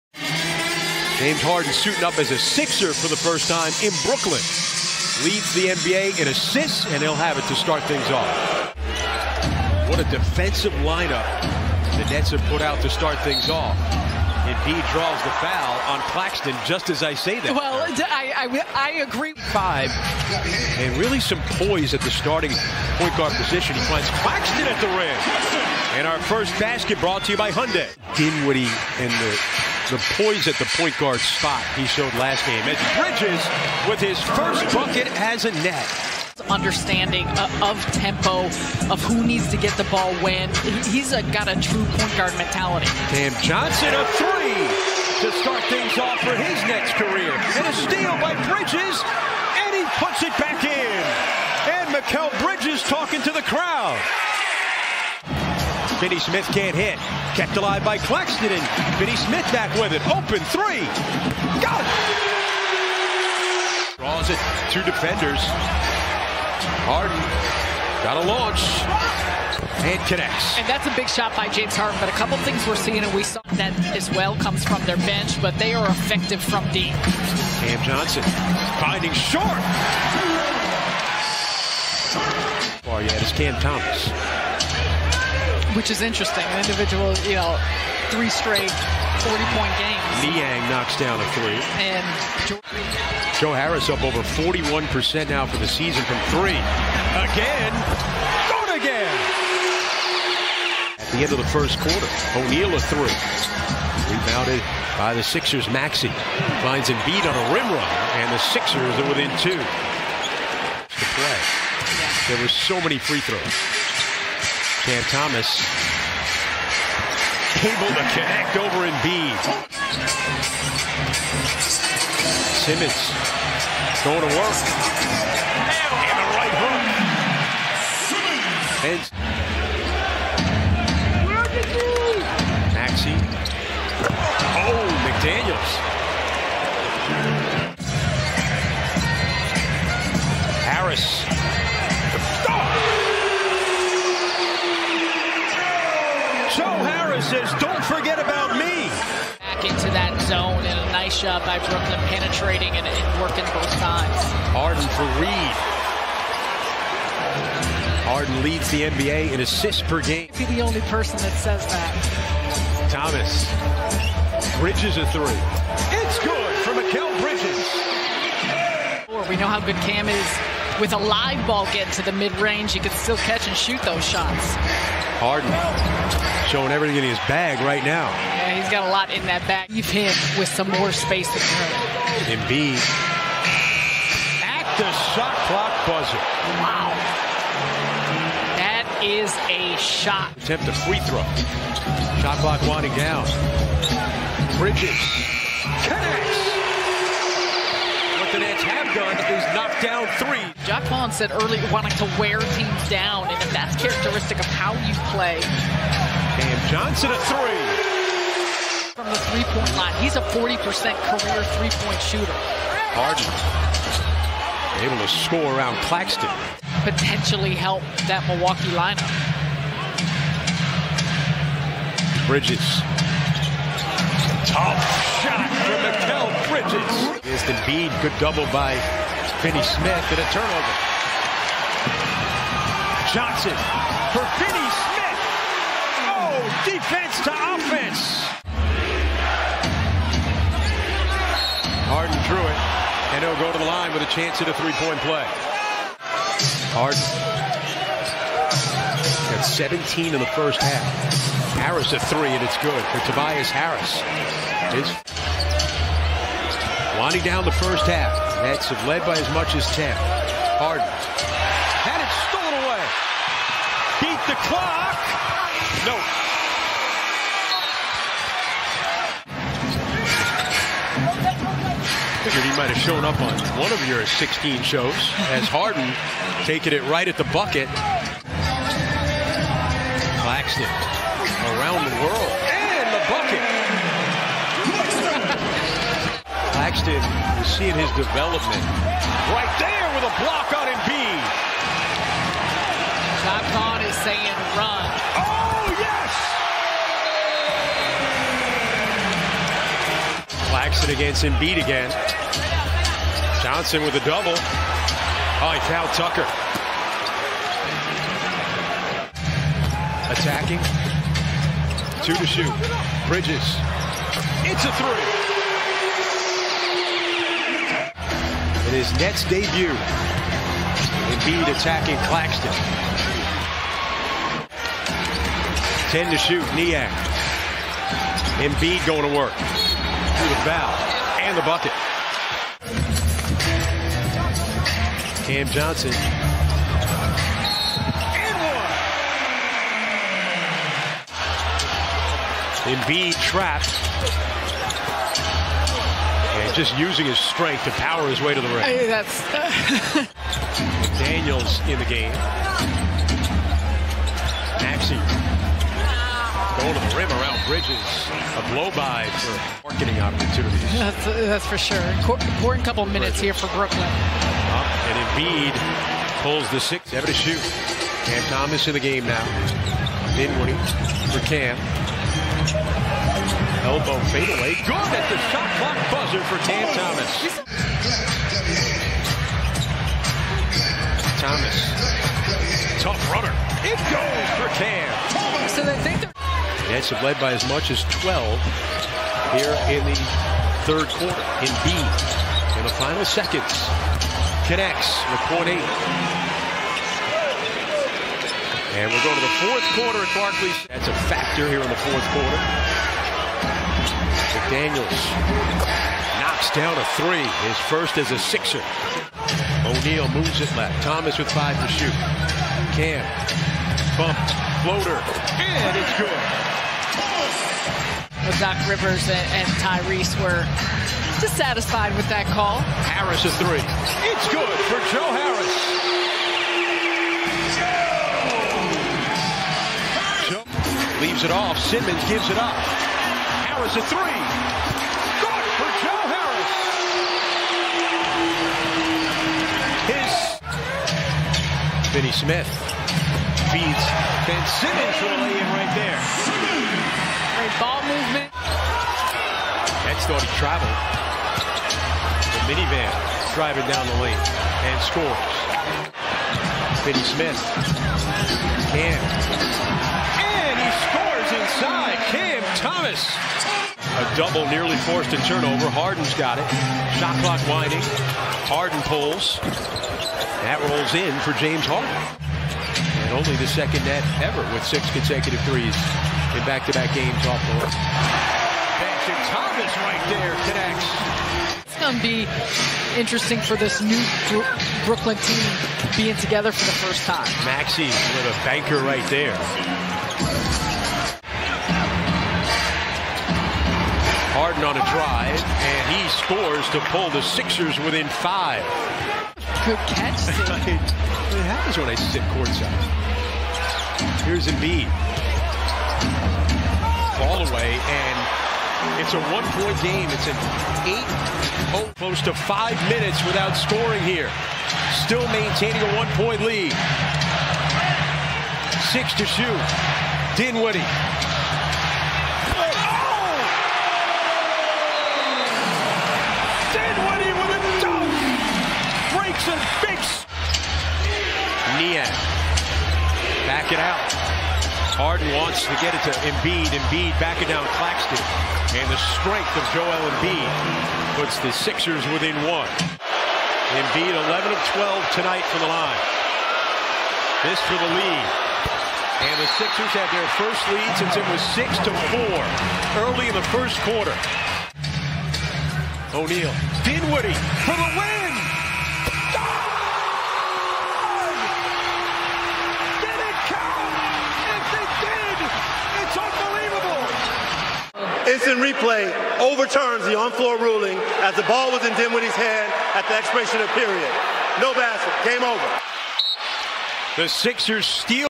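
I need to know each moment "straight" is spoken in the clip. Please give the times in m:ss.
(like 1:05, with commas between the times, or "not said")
1:28.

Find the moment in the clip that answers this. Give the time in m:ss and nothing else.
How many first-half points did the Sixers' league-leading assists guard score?
4:09.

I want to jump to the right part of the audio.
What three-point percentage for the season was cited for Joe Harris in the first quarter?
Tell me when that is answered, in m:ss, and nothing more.
1:34.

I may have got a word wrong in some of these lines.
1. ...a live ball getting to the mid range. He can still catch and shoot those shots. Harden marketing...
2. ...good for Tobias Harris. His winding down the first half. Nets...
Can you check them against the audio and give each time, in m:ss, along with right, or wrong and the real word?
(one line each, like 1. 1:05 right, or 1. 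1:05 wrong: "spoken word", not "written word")
1. 2:50 wrong: "showing", not "marketing"
2. 4:12 right.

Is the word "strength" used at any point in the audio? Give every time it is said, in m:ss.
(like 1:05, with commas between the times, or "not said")
5:47, 8:59.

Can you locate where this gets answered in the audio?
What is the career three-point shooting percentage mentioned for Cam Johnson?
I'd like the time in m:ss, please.
3:30.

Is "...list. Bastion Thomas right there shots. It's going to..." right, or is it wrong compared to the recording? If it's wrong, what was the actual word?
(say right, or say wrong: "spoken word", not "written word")
wrong: "connects", not "shots".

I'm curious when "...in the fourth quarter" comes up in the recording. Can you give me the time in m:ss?
6:41.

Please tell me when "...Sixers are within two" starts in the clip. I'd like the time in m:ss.
1:48.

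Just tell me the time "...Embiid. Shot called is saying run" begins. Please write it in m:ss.
4:50.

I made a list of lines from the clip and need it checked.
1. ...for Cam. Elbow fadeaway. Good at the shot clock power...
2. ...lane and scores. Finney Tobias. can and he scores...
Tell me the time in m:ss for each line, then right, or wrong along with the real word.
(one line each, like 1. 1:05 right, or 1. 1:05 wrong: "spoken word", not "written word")
1. 6:11 wrong: "buzzer", not "power"
2. 7:34 wrong: "Smith", not "Tobias".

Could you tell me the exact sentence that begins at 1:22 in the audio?
Far oh, yet yeah, is Cam Thomas which is interesting.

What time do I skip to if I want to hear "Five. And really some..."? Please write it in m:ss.
0:19.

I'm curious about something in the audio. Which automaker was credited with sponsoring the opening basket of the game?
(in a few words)
Hyundai.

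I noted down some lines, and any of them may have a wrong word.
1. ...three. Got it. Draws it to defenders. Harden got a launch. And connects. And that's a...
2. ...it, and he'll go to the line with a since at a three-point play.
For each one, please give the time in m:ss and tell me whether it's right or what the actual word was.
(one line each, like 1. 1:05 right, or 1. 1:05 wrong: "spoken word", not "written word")
1. 1:00 right
2. 4:02 wrong: "chance", not "since".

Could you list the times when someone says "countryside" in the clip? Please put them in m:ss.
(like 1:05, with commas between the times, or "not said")
not said.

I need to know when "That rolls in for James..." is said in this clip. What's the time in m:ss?
7:50.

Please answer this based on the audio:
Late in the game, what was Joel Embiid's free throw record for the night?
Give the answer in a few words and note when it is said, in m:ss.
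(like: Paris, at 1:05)
11 of 12, at 9:04.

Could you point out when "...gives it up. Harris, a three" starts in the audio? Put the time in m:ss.
7:12.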